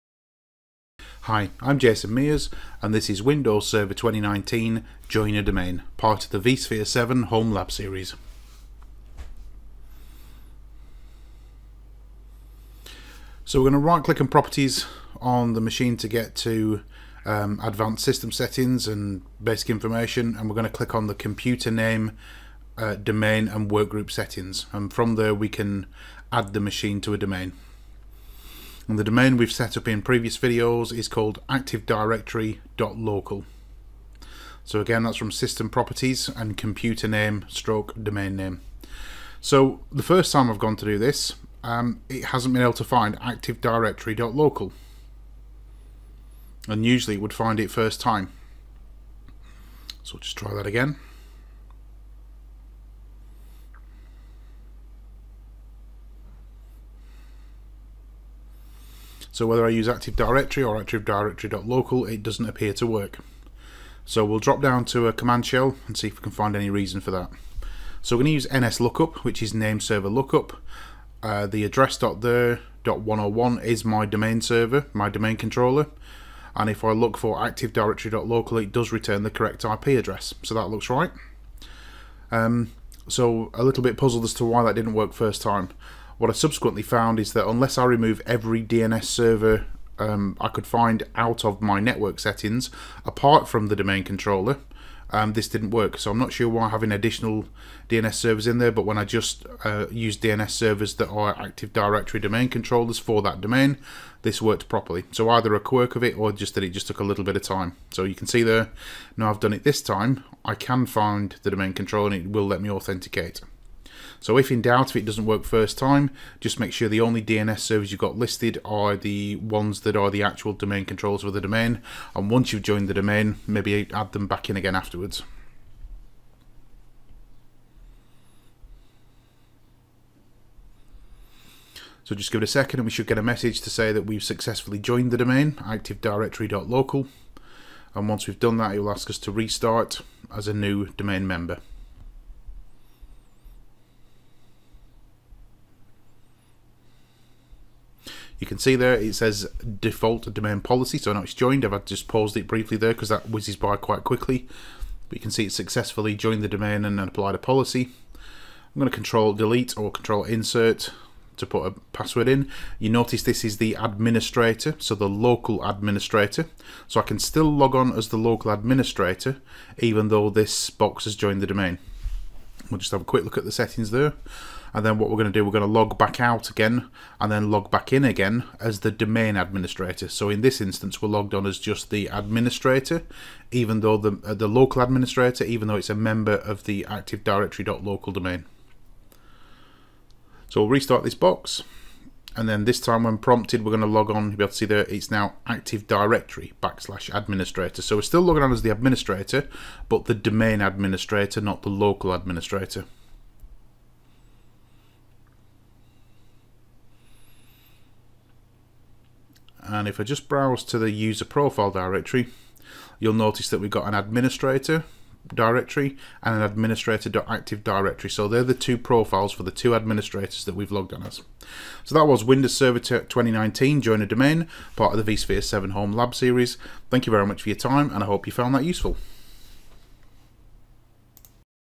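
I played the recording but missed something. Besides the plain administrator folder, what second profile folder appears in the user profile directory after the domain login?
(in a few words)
administrator.active directory.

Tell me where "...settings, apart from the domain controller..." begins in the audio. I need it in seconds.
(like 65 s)
92 s.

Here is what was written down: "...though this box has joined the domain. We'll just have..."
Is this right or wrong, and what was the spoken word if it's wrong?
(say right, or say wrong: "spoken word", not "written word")
right.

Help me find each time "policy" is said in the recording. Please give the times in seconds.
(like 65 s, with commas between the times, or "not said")
150 s, 157 s.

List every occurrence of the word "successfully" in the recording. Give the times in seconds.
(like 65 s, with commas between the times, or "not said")
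134 s, 155 s.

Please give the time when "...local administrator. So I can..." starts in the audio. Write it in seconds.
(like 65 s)
165 s.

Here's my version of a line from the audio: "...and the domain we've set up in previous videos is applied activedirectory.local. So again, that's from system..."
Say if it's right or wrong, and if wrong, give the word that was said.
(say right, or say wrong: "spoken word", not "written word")
wrong: "called", not "applied".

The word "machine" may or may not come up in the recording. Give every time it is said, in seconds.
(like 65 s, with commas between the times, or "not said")
15 s, 26 s.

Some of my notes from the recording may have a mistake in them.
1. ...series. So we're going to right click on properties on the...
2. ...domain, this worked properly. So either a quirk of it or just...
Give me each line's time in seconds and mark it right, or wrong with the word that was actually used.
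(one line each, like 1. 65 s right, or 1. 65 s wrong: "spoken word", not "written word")
1. 7 s right
2. 103 s right.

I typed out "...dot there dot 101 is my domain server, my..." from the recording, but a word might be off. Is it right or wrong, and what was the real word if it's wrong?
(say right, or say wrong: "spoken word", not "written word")
right.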